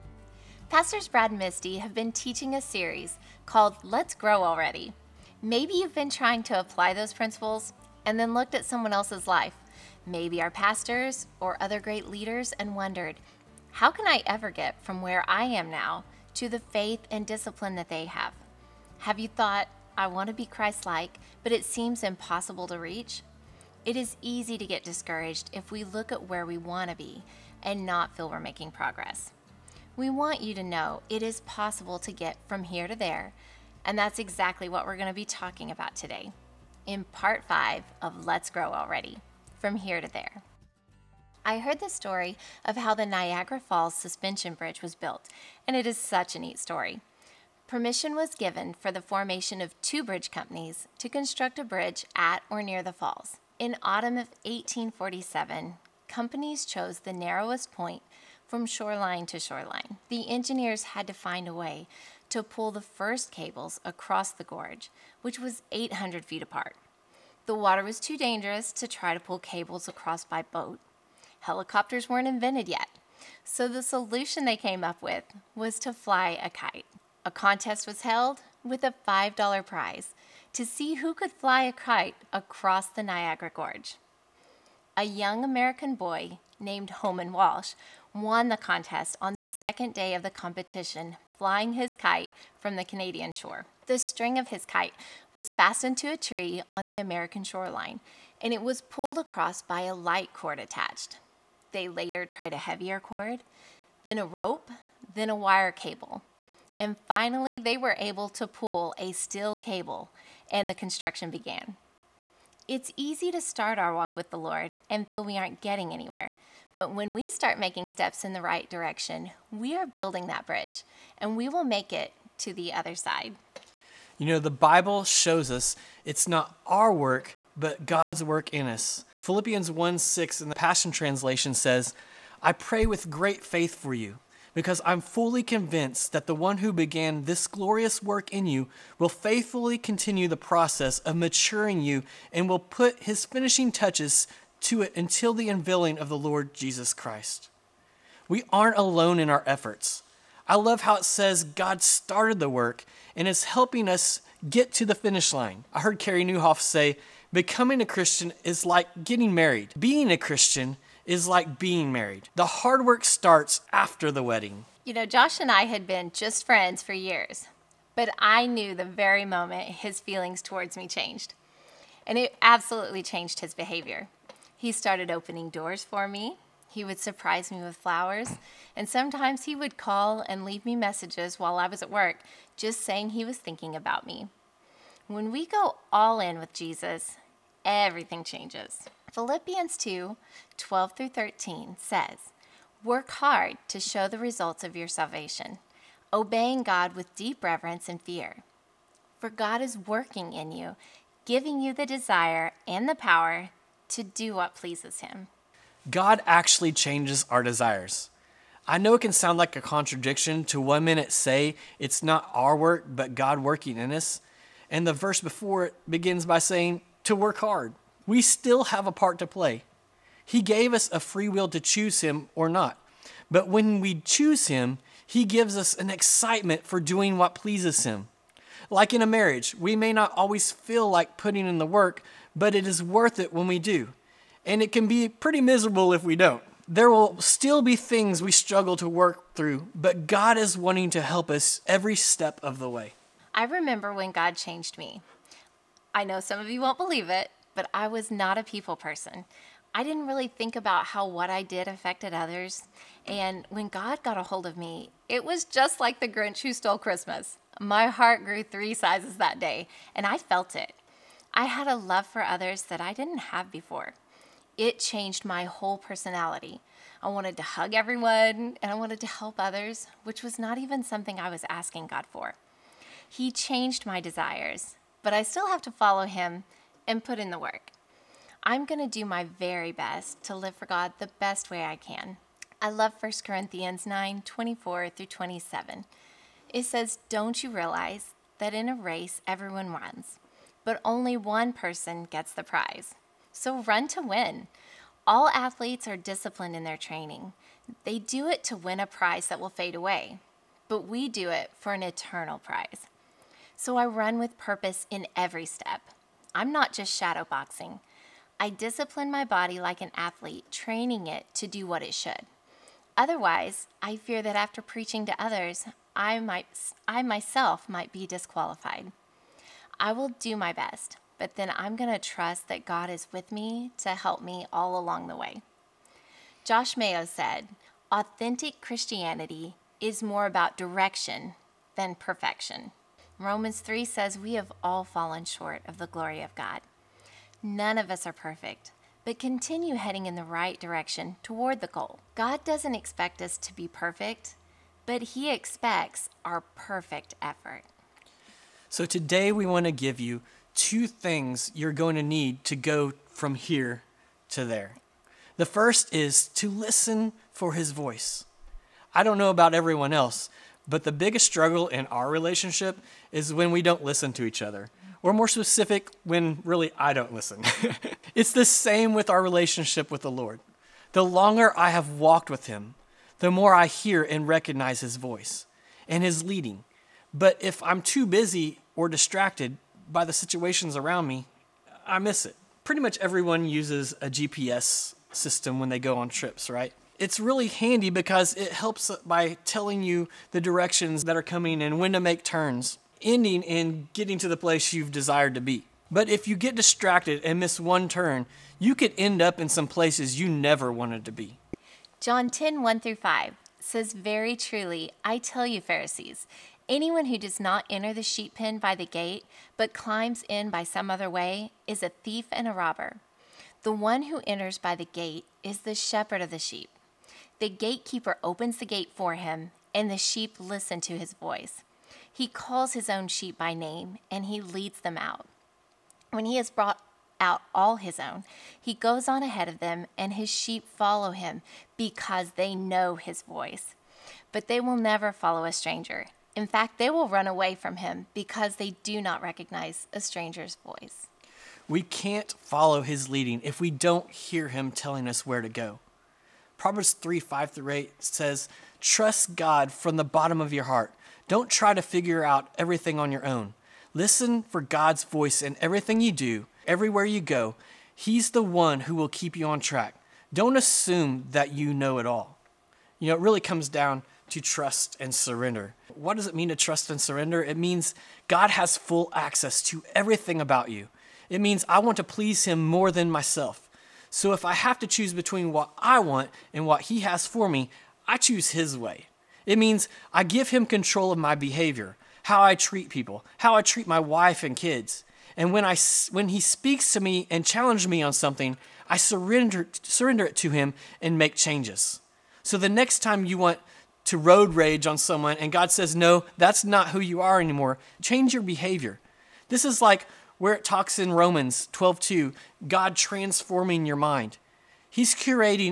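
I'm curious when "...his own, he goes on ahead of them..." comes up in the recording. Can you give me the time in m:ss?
7:07.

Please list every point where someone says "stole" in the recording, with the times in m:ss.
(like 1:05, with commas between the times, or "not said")
4:16.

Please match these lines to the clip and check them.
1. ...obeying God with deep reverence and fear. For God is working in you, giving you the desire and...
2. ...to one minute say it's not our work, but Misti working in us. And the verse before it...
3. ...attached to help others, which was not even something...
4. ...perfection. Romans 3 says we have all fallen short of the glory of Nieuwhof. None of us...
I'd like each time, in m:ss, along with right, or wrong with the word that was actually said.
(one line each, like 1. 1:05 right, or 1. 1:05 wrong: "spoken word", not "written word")
1. 3:16 right
2. 3:30 wrong: "God", not "Misti"
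3. 4:28 wrong: "wanted", not "attached"
4. 5:31 wrong: "God", not "Nieuwhof".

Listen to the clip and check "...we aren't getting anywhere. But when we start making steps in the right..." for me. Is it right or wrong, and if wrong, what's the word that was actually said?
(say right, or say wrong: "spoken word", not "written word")
right.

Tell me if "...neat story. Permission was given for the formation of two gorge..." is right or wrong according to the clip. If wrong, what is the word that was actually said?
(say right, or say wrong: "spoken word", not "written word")
wrong: "bridge", not "gorge".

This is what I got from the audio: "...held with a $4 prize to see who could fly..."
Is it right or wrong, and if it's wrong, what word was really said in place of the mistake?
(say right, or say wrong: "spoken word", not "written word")
wrong: "5", not "4".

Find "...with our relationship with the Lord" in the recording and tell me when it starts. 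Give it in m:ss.
6:08.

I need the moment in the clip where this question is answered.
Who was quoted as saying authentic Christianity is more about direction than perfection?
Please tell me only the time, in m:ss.
5:26.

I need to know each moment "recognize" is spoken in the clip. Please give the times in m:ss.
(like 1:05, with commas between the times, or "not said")
6:14, 7:19.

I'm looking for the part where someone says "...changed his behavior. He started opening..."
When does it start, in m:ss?
2:53.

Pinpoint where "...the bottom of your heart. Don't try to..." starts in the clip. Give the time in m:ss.
7:29.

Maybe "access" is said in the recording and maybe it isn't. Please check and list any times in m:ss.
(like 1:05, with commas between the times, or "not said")
7:49.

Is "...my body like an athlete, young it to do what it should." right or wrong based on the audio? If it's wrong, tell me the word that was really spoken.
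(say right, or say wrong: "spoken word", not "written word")
wrong: "training", not "young".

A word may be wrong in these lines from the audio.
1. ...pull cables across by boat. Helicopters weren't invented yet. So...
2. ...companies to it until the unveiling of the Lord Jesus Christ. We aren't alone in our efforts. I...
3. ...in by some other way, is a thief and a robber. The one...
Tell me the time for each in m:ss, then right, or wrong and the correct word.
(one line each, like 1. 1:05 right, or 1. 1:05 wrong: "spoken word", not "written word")
1. 1:09 right
2. 2:23 wrong: "touches", not "companies"
3. 6:50 right.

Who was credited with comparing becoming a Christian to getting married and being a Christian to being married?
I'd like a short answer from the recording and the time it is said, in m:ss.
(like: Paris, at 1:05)
Carey Nieuwhof, at 2:35.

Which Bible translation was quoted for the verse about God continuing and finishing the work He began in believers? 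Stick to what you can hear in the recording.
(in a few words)
Passion Translation.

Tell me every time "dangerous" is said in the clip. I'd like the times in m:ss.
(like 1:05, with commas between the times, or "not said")
1:08.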